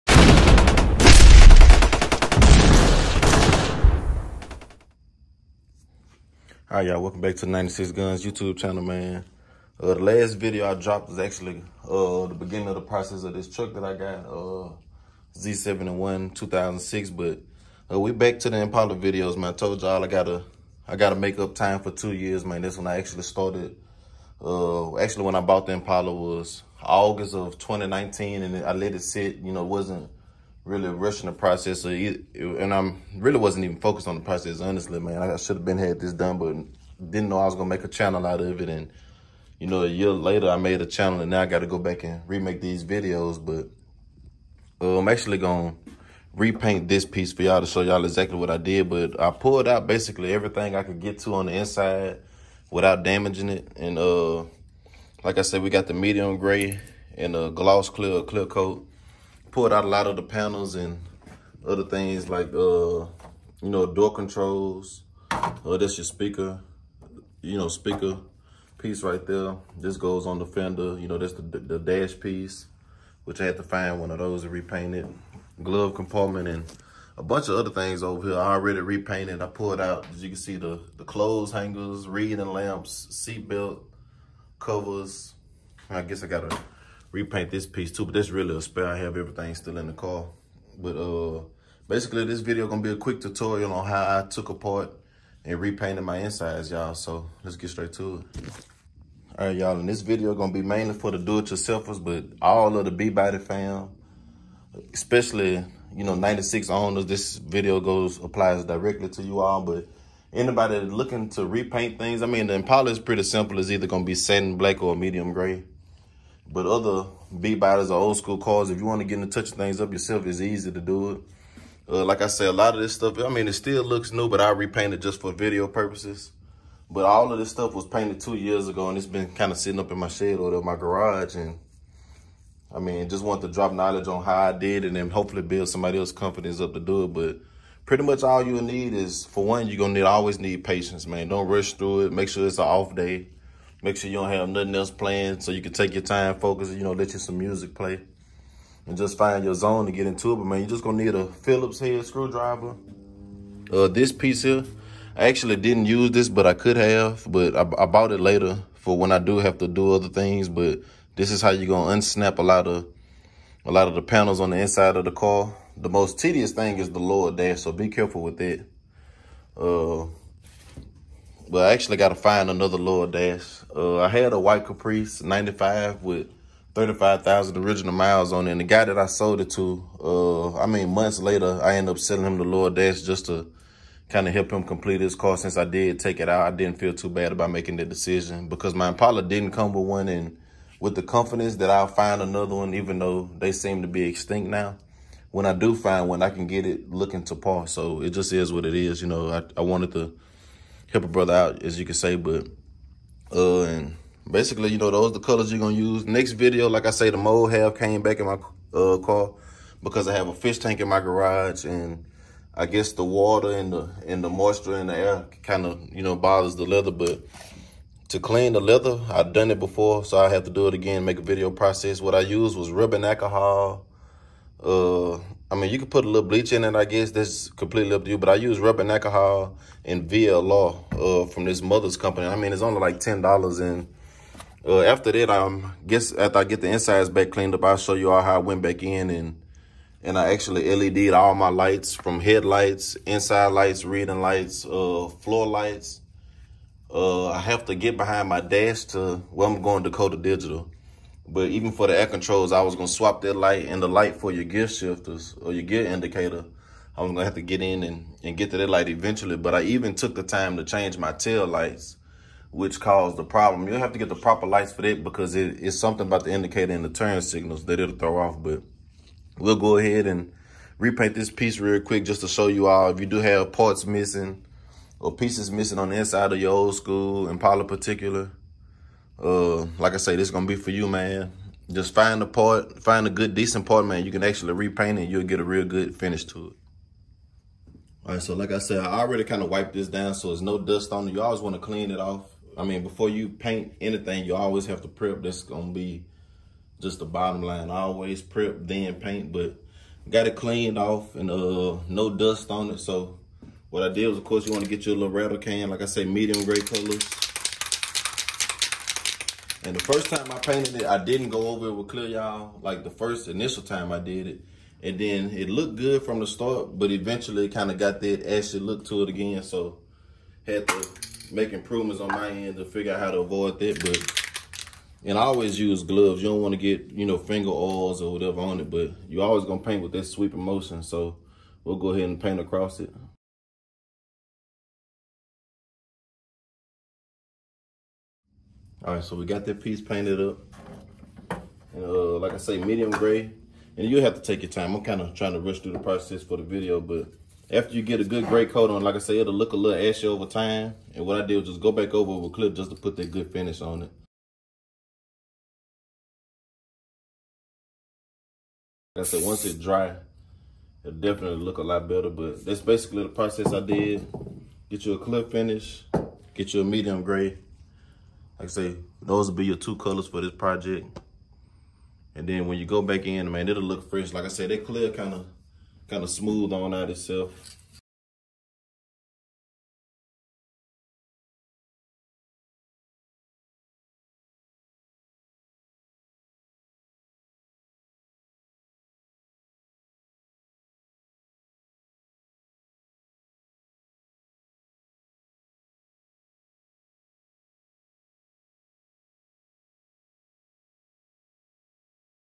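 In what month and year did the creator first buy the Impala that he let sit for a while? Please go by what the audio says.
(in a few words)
August 2019.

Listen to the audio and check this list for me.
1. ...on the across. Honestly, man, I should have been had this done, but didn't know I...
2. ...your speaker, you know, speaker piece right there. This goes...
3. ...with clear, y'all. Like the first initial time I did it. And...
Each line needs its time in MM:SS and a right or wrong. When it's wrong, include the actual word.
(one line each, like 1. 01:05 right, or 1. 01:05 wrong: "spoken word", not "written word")
1. 00:34 wrong: "process", not "across"
2. 01:05 right
3. 05:11 right.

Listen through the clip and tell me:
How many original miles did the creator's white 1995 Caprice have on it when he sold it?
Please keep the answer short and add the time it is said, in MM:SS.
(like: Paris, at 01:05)
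35,000, at 02:56.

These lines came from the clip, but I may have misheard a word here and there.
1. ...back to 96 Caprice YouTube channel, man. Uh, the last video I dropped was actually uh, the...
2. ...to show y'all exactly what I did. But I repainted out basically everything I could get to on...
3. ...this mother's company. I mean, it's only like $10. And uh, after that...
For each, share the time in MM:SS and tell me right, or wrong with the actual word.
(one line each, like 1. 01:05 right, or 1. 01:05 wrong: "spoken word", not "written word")
1. 00:07 wrong: "Guns", not "Caprice"
2. 00:47 wrong: "pulled", not "repainted"
3. 03:51 right.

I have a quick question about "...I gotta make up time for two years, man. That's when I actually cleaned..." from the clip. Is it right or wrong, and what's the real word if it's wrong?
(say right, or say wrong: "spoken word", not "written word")
wrong: "started", not "cleaned".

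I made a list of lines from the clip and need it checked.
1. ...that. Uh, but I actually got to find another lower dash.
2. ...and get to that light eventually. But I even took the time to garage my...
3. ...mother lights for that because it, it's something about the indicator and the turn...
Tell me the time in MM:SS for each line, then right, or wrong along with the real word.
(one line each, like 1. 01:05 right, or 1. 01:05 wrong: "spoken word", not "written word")
1. 02:48 right
2. 04:18 wrong: "change", not "garage"
3. 04:24 wrong: "proper", not "mother".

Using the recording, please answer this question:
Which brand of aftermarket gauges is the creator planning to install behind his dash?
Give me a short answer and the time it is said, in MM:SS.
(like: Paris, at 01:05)
Dakota Digital, at 04:09.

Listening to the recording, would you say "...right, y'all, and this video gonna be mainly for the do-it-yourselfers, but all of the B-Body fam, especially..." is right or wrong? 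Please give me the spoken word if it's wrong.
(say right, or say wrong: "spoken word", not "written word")
right.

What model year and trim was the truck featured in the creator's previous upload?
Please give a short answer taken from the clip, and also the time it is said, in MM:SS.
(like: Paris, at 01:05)
Z71 2006, at 00:15.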